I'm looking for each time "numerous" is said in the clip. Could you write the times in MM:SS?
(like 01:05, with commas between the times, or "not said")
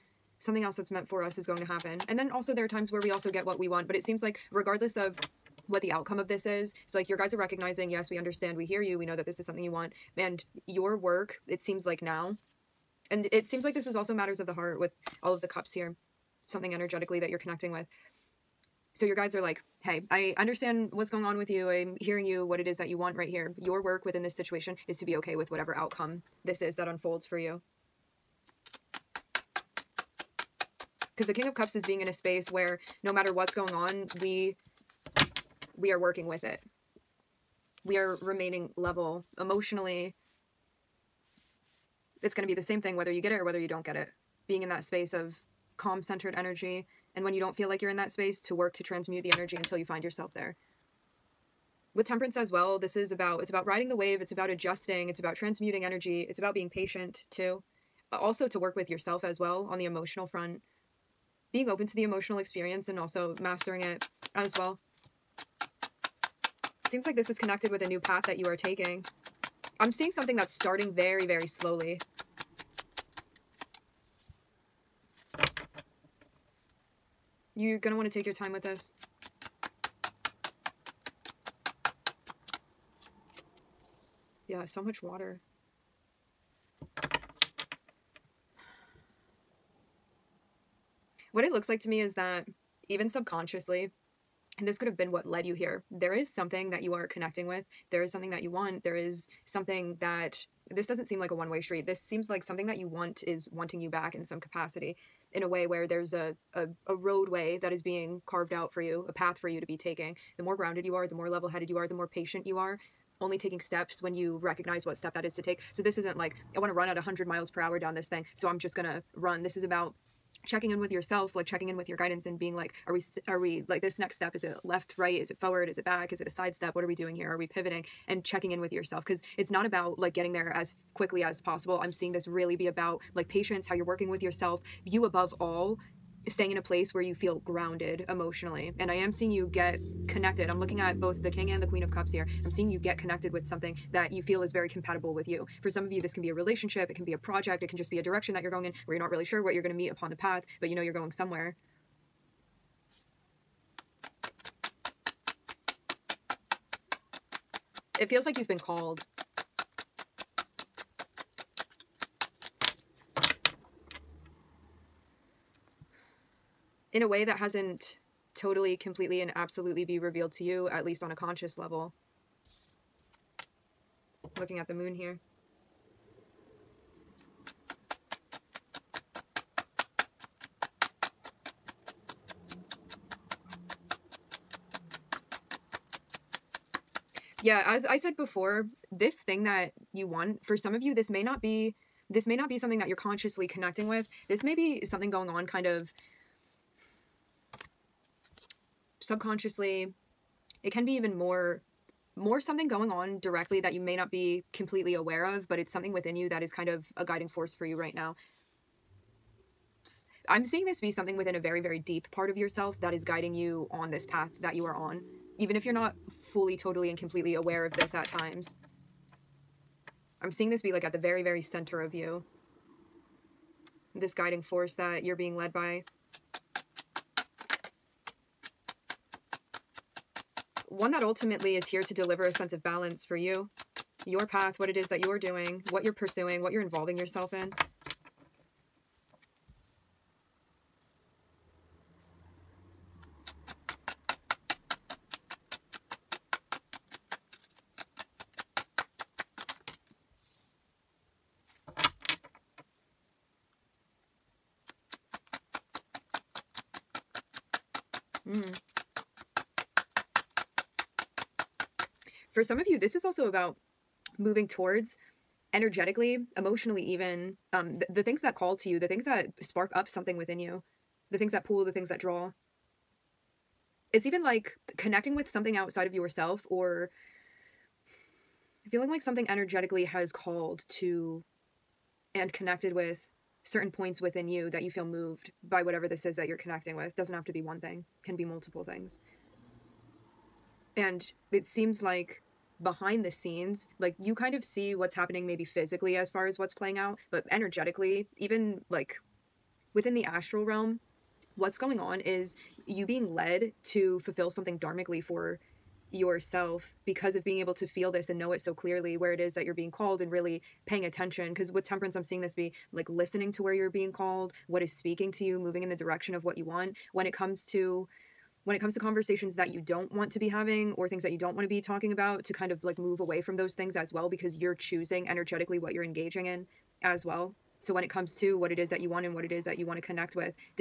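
not said.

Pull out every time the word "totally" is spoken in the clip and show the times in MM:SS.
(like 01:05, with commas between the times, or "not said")
02:48, 03:36.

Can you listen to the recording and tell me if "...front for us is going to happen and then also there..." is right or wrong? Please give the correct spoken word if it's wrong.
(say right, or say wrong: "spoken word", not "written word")
wrong: "meant", not "front".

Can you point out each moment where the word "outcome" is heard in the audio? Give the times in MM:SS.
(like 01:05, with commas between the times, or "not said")
00:05, 00:25.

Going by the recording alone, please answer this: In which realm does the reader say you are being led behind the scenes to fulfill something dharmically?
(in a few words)
The astral realm.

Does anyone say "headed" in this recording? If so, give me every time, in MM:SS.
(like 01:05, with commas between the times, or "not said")
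01:51.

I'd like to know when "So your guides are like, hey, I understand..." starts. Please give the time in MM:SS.
00:18.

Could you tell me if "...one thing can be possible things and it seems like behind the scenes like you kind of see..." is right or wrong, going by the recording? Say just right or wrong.
wrong.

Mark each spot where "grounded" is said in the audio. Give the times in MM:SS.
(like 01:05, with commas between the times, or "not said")
01:50, 02:17.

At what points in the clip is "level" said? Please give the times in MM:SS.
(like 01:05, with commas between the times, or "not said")
00:38, 01:51, 02:51.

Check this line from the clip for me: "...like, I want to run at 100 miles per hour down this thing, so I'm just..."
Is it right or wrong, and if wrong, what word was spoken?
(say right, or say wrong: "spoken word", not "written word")
right.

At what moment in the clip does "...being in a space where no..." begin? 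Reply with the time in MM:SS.
00:31.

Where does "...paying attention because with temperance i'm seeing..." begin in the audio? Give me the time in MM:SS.
05:10.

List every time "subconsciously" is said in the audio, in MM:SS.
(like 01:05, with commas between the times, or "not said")
01:33, 03:19.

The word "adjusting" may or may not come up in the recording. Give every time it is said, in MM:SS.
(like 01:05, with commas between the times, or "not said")
00:54.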